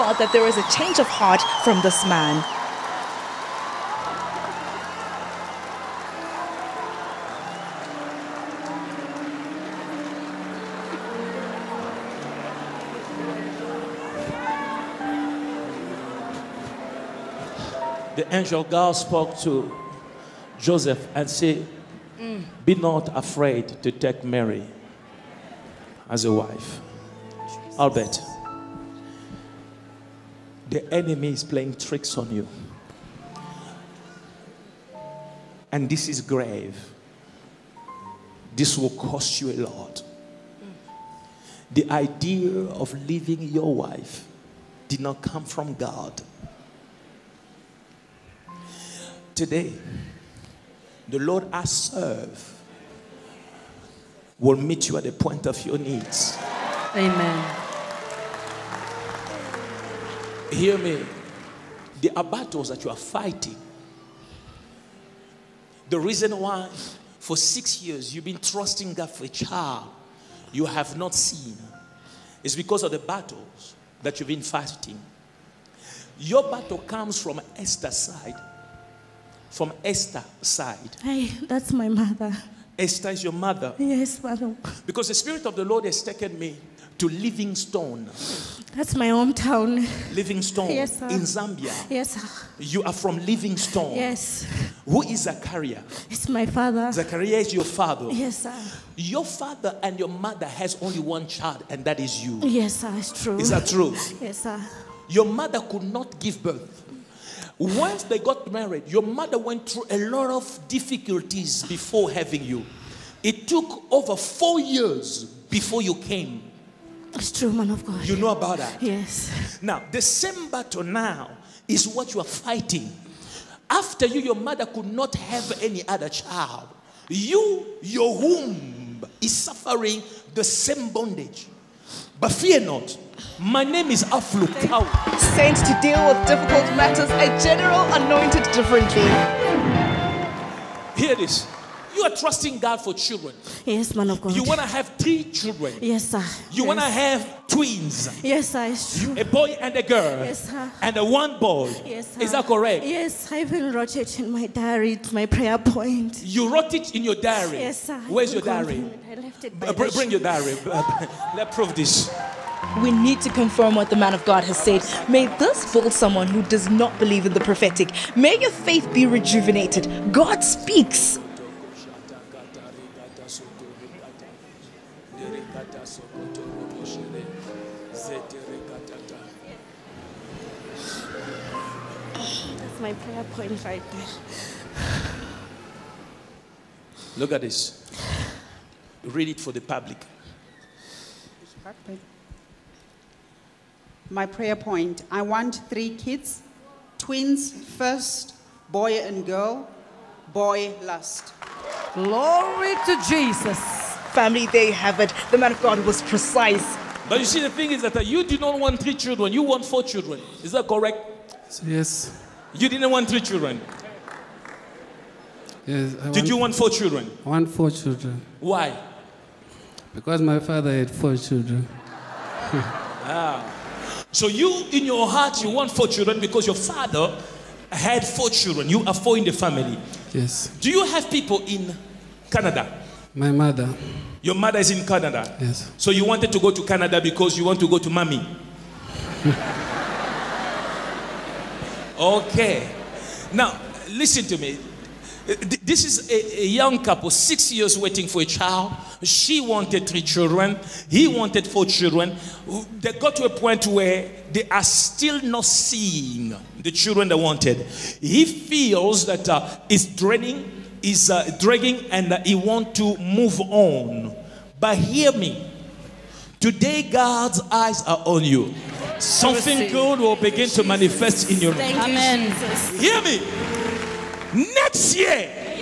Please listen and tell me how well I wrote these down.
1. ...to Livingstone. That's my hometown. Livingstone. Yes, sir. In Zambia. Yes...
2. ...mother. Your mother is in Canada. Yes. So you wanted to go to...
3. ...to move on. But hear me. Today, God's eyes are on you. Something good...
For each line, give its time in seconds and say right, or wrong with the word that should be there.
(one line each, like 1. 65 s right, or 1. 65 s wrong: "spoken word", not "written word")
1. 86 s right
2. 233 s right
3. 262 s right.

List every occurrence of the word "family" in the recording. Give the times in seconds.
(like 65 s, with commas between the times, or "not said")
204 s, 229 s.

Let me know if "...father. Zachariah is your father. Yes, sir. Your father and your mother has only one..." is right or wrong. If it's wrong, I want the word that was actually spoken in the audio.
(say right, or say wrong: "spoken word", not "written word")
right.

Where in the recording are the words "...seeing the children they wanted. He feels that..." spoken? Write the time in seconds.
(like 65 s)
255 s.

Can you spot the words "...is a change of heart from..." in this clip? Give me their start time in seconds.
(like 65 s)
0 s.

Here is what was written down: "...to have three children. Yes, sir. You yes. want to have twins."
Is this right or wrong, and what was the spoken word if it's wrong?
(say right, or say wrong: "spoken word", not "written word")
right.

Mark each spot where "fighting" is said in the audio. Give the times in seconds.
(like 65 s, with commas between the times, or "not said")
62 s, 74 s, 122 s.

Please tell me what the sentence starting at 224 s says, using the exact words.
So you, in your heart, you want four children because your father had four children.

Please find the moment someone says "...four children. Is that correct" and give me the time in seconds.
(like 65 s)
209 s.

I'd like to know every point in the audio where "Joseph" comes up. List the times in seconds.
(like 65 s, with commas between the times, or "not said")
20 s.